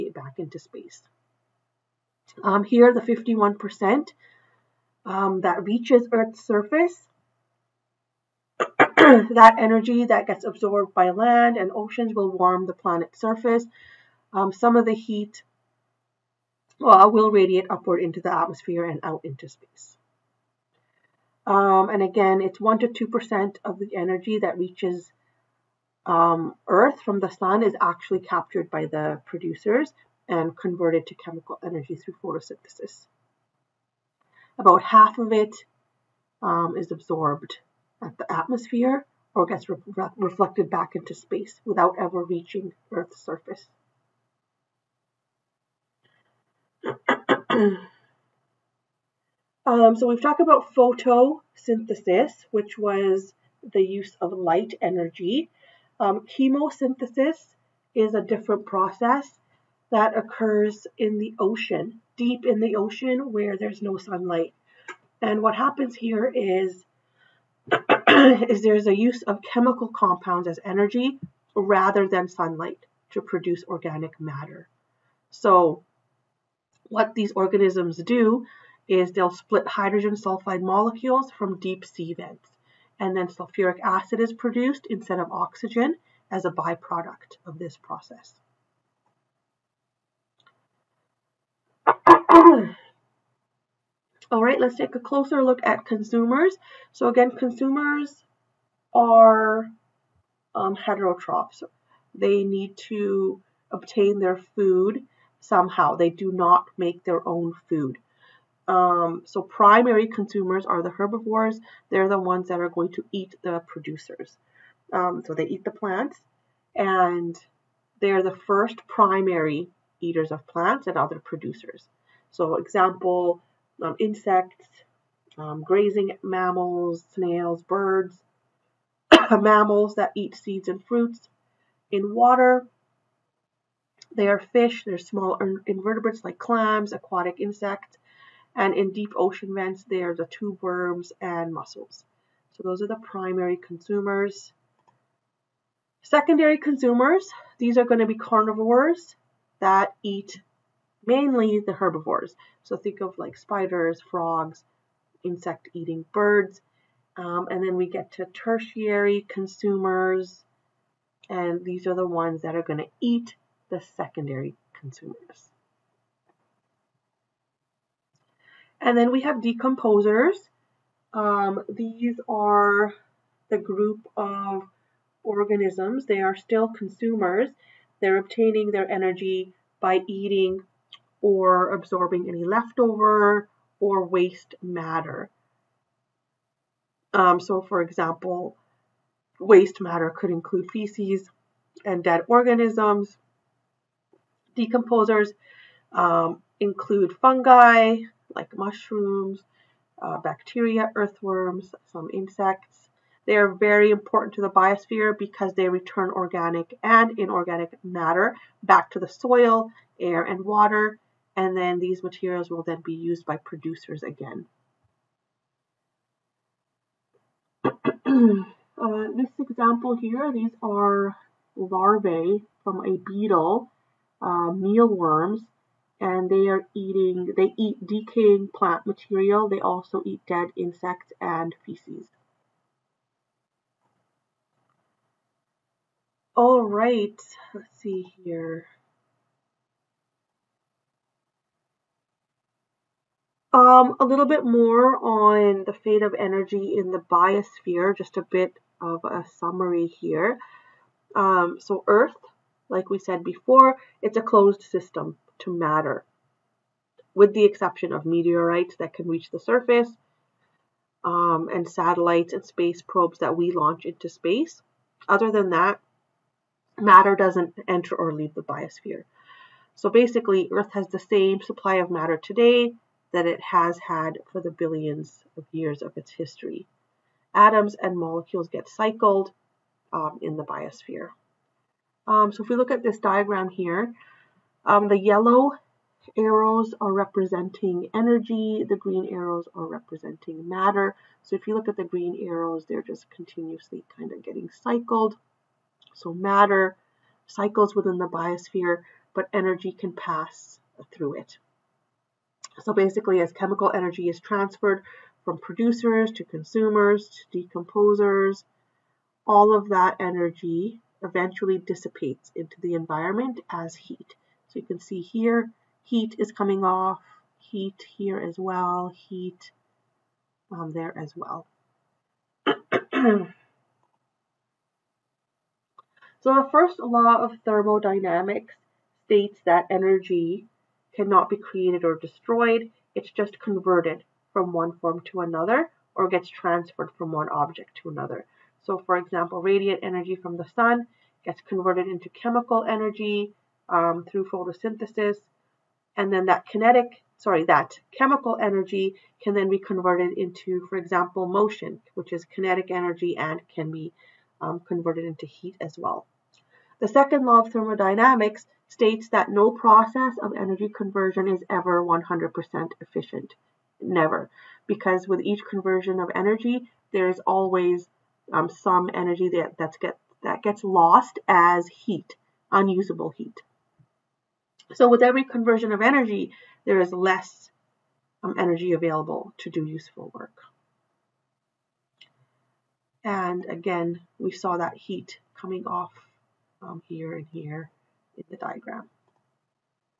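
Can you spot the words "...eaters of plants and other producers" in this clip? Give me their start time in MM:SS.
01:59.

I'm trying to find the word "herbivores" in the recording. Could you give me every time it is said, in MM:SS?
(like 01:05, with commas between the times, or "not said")
01:50, 02:31.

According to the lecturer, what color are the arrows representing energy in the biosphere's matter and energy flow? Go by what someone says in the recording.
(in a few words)
yellow.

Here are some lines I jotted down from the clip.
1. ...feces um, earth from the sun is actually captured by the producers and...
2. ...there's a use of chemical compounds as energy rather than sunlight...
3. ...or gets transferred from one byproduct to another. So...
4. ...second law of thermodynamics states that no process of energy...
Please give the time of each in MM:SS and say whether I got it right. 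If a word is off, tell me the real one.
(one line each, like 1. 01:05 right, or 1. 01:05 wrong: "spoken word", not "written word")
1. 00:24 wrong: "reaches", not "feces"
2. 01:08 right
3. 05:35 wrong: "object", not "byproduct"
4. 05:56 right.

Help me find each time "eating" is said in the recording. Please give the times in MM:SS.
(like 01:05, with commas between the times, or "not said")
02:35, 03:00, 03:46.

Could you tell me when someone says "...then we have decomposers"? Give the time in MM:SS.
02:48.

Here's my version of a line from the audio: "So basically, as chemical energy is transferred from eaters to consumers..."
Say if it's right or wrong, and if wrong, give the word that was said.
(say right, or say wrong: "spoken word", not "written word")
wrong: "producers", not "eaters".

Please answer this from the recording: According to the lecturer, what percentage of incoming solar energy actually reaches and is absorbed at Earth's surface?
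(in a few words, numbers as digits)
51%.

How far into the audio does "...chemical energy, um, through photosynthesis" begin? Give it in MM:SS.
05:42.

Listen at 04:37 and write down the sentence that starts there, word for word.
Atoms and molecules get cycled um, in the biosphere.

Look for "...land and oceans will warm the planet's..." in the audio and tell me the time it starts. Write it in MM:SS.
00:11.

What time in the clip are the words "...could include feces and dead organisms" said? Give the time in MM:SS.
03:10.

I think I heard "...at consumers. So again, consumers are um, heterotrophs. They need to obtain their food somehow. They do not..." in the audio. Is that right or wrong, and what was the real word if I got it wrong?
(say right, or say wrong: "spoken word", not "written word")
right.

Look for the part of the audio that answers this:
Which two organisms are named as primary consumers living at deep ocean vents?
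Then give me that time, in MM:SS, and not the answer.
02:20.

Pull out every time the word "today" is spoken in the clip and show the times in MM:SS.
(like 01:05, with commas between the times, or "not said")
04:32.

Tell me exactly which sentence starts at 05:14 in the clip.
So you can see here, heat is coming off, heat here as well, heat um, there as well.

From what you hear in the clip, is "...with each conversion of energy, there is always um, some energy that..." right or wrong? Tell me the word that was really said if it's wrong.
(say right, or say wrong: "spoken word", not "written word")
right.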